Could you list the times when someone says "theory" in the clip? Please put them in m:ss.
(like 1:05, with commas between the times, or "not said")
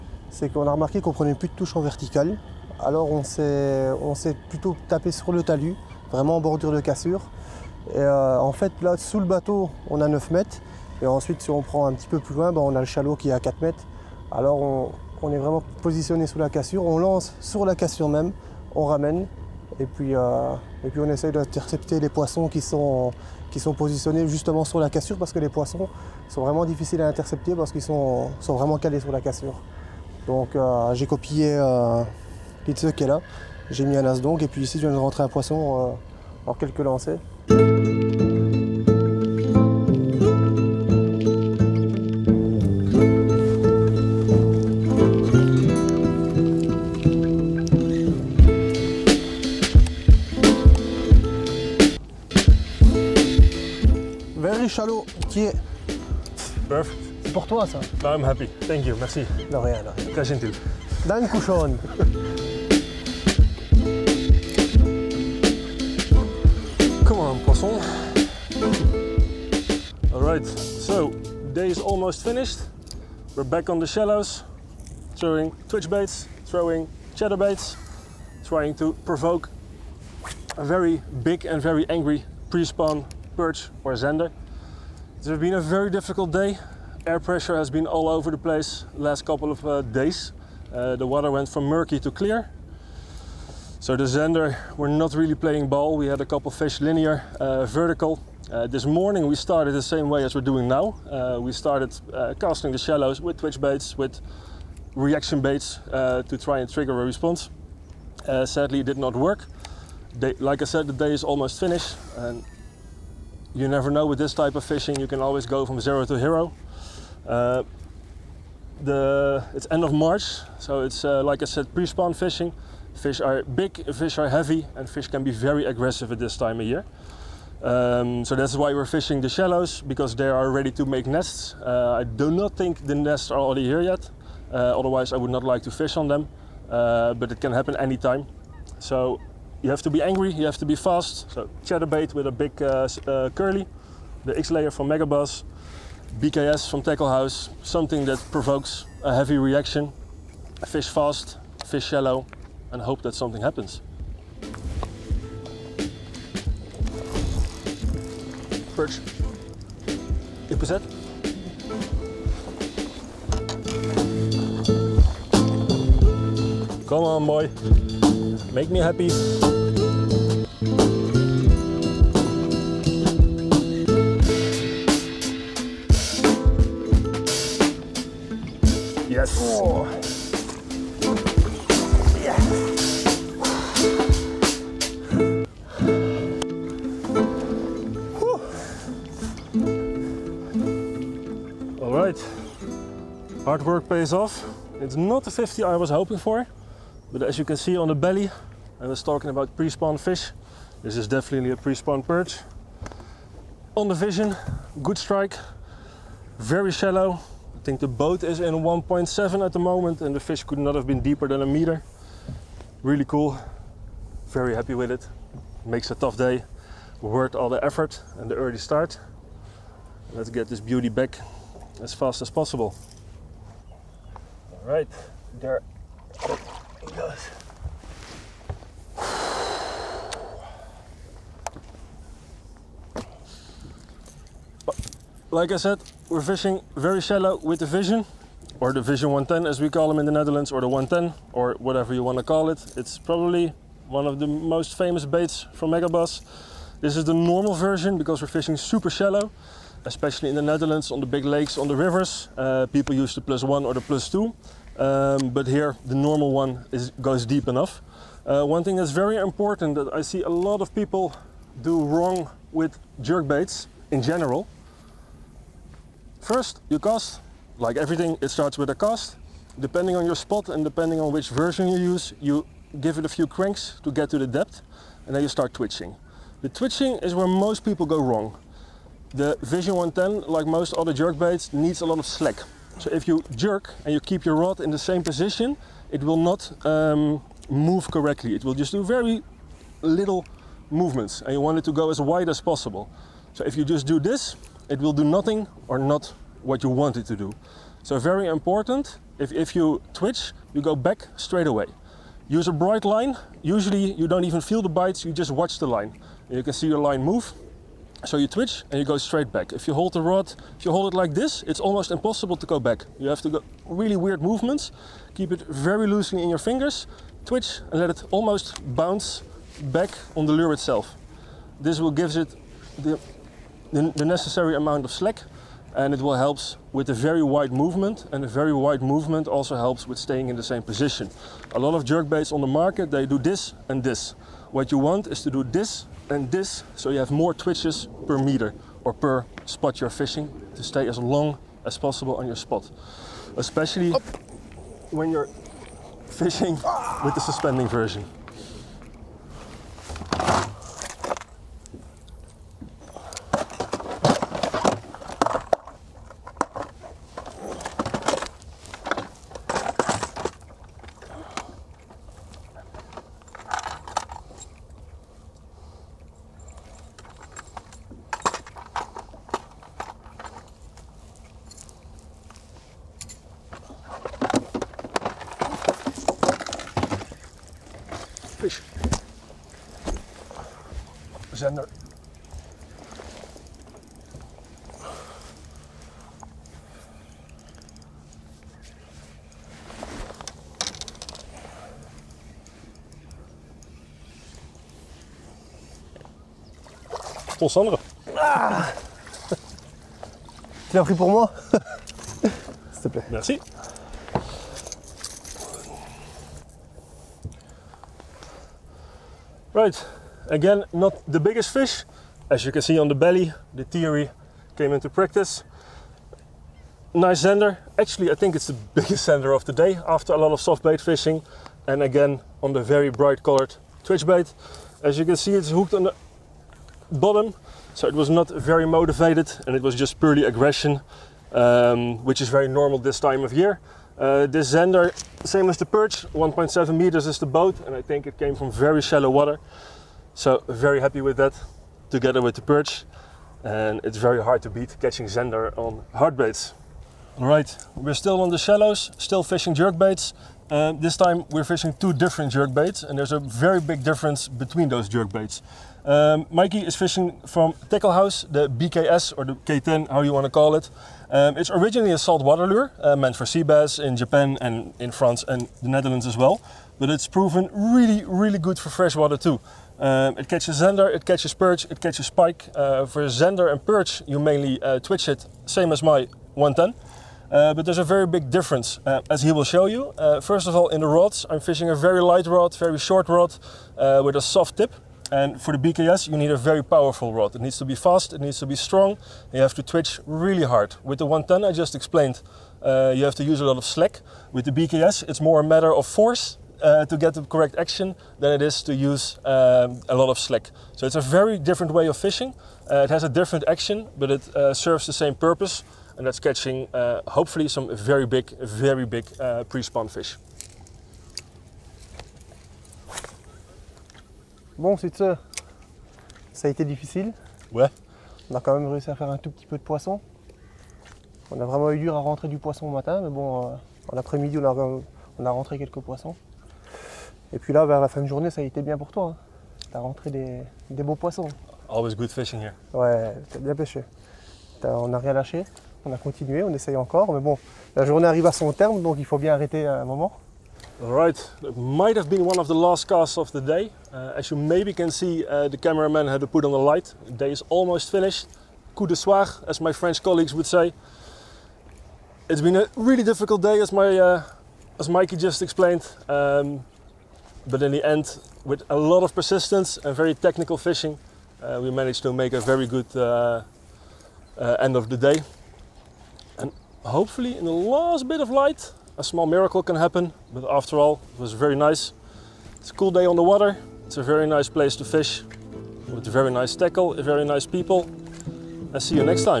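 6:53.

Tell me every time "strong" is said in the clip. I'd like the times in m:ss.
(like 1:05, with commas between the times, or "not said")
8:08.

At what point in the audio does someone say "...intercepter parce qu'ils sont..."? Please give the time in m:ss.
0:27.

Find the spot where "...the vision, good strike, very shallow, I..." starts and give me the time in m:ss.
3:23.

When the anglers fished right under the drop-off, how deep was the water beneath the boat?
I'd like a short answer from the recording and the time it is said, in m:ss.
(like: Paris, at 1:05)
9 meters, at 0:10.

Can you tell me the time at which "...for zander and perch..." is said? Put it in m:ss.
7:52.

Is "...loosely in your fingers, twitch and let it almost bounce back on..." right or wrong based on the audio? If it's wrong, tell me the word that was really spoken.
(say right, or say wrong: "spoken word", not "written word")
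right.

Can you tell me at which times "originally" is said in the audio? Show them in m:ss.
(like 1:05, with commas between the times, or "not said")
7:41.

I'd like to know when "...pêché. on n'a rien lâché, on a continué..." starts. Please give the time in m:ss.
8:53.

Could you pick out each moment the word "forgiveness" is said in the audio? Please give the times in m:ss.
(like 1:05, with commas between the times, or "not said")
not said.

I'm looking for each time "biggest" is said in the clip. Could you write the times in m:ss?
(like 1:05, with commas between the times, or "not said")
6:51, 6:58.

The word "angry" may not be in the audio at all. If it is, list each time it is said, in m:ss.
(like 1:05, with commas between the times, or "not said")
1:21, 2:20.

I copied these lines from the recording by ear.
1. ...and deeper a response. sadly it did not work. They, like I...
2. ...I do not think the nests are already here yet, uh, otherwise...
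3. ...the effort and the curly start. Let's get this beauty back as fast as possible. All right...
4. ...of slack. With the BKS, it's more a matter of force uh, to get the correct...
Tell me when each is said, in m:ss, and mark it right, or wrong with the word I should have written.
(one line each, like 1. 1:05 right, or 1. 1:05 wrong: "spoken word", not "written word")
1. 1:46 wrong: "trigger", not "deeper"
2. 2:12 right
3. 3:37 wrong: "early", not "curly"
4. 8:13 right.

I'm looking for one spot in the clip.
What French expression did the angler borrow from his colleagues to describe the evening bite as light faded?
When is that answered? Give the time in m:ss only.
9:08.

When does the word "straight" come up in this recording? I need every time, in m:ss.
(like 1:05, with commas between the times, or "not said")
5:01, 5:08.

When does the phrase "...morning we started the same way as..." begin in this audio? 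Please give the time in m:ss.
1:38.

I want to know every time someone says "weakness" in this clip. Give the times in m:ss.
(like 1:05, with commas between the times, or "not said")
not said.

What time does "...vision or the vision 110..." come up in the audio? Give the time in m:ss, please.
3:57.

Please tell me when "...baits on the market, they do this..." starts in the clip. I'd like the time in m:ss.
5:32.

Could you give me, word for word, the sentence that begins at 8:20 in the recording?
So it's a very different way of fishing.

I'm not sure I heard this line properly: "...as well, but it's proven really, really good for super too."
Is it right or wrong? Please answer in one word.
wrong.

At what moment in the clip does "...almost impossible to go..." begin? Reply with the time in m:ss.
5:11.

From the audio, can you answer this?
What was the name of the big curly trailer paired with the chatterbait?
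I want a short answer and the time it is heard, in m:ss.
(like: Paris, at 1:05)
X layer, at 2:24.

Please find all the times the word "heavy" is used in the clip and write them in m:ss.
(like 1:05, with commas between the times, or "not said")
2:04, 2:29.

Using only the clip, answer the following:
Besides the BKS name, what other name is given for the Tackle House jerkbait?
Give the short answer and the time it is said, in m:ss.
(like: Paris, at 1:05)
K10, at 7:39.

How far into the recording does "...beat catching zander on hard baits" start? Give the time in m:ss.
7:24.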